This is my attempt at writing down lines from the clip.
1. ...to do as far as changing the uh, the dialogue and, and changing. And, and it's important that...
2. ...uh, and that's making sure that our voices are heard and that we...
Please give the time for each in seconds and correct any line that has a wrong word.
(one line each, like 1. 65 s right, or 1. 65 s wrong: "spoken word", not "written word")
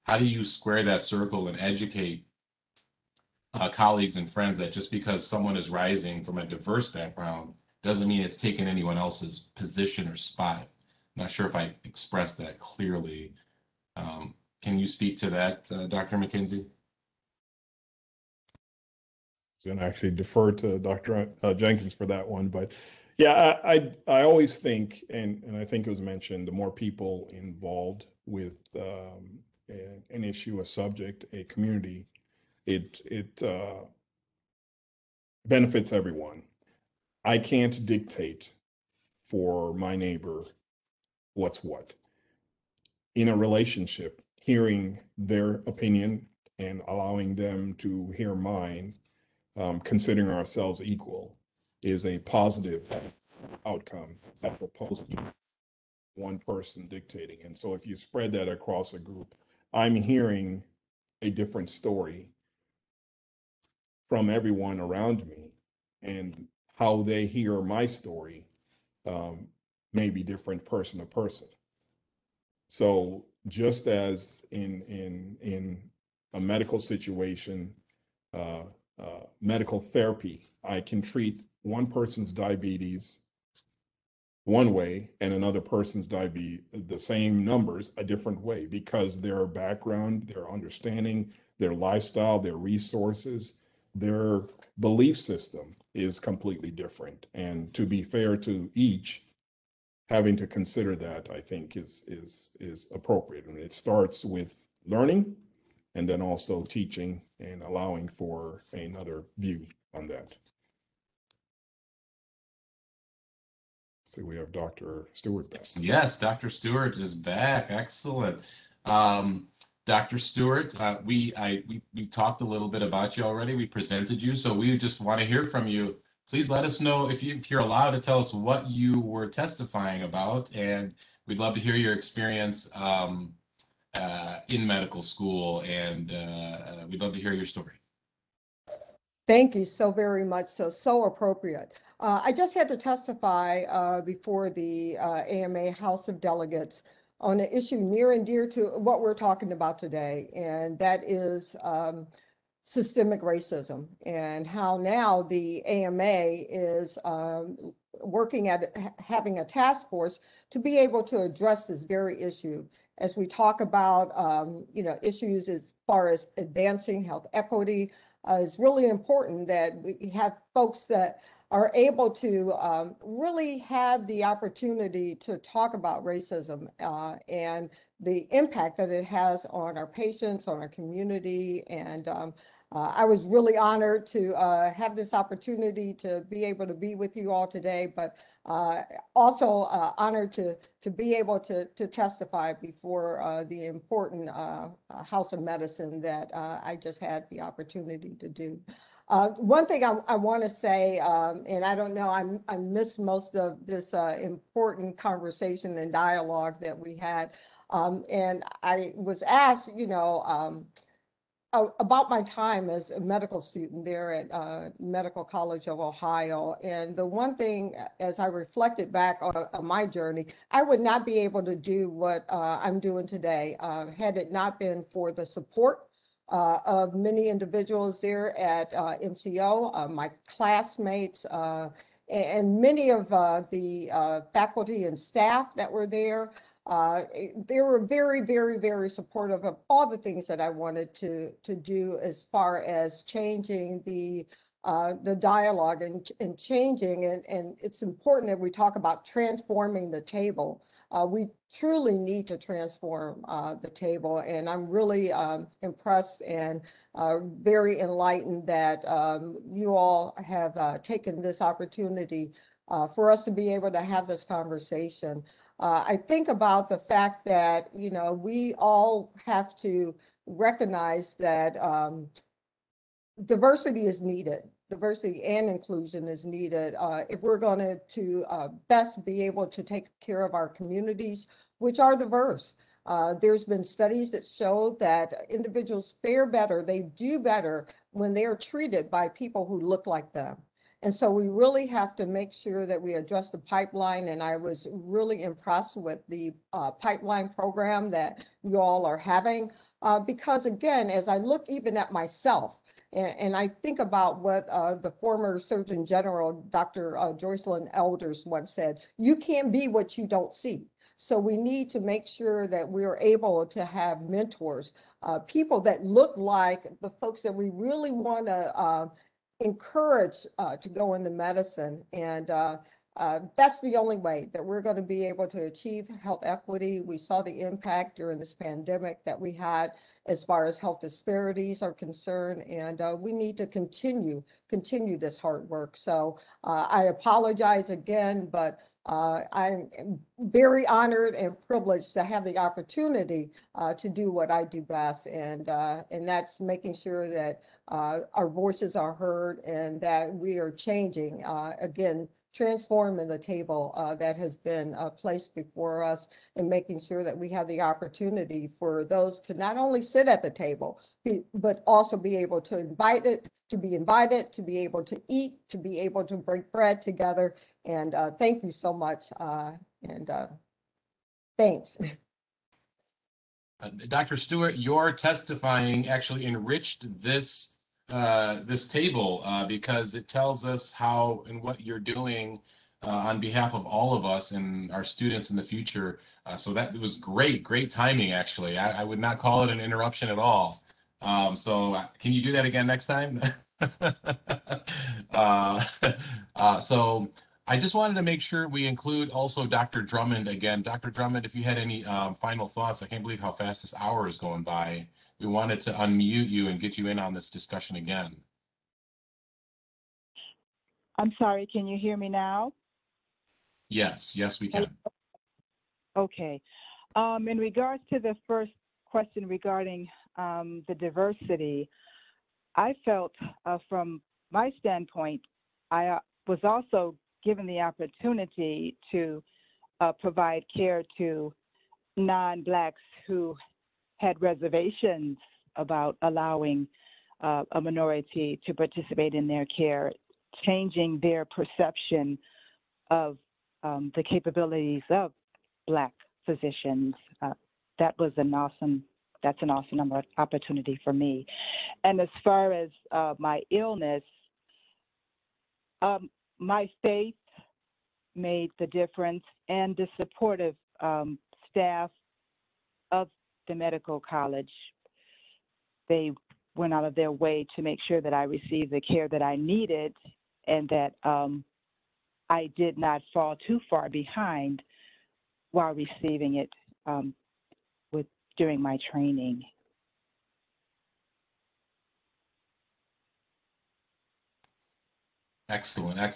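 1. 241 s right
2. 345 s right.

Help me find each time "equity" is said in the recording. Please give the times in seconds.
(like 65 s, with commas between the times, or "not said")
167 s, 326 s.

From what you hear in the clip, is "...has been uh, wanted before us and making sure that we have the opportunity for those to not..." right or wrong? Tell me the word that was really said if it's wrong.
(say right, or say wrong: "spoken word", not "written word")
wrong: "placed", not "wanted".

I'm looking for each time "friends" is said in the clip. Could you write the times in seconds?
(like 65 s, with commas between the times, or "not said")
4 s.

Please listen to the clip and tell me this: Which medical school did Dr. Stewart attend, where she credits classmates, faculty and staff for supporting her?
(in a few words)
Medical College of Ohio.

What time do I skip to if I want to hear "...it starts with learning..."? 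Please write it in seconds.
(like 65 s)
103 s.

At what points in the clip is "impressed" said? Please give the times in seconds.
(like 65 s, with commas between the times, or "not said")
255 s, 295 s.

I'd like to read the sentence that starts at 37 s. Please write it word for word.
I can't dictate for my neighbor what's what in a relationship.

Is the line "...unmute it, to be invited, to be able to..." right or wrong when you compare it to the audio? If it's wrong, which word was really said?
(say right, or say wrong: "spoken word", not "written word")
wrong: "invite", not "unmute".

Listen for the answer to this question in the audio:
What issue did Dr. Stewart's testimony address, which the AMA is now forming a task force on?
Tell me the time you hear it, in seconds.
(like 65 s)
152 s.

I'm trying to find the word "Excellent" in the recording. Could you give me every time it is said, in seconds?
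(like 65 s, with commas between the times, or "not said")
117 s, 485 s.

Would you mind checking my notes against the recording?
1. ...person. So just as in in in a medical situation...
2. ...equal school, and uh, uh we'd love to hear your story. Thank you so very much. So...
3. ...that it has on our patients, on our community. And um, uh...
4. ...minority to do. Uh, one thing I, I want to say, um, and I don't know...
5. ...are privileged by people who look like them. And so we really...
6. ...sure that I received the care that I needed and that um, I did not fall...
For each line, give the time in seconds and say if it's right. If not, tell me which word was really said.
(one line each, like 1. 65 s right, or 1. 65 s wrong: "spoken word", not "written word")
1. 71 s right
2. 134 s wrong: "medical", not "equal"
3. 178 s right
4. 197 s wrong: "opportunity", not "minority"
5. 288 s wrong: "treated", not "privileged"
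6. 467 s right.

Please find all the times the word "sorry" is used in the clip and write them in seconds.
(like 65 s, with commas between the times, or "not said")
411 s.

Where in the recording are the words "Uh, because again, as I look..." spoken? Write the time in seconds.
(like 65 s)
299 s.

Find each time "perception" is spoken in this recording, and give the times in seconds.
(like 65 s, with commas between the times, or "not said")
441 s.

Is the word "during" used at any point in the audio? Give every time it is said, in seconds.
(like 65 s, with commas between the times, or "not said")
327 s, 478 s.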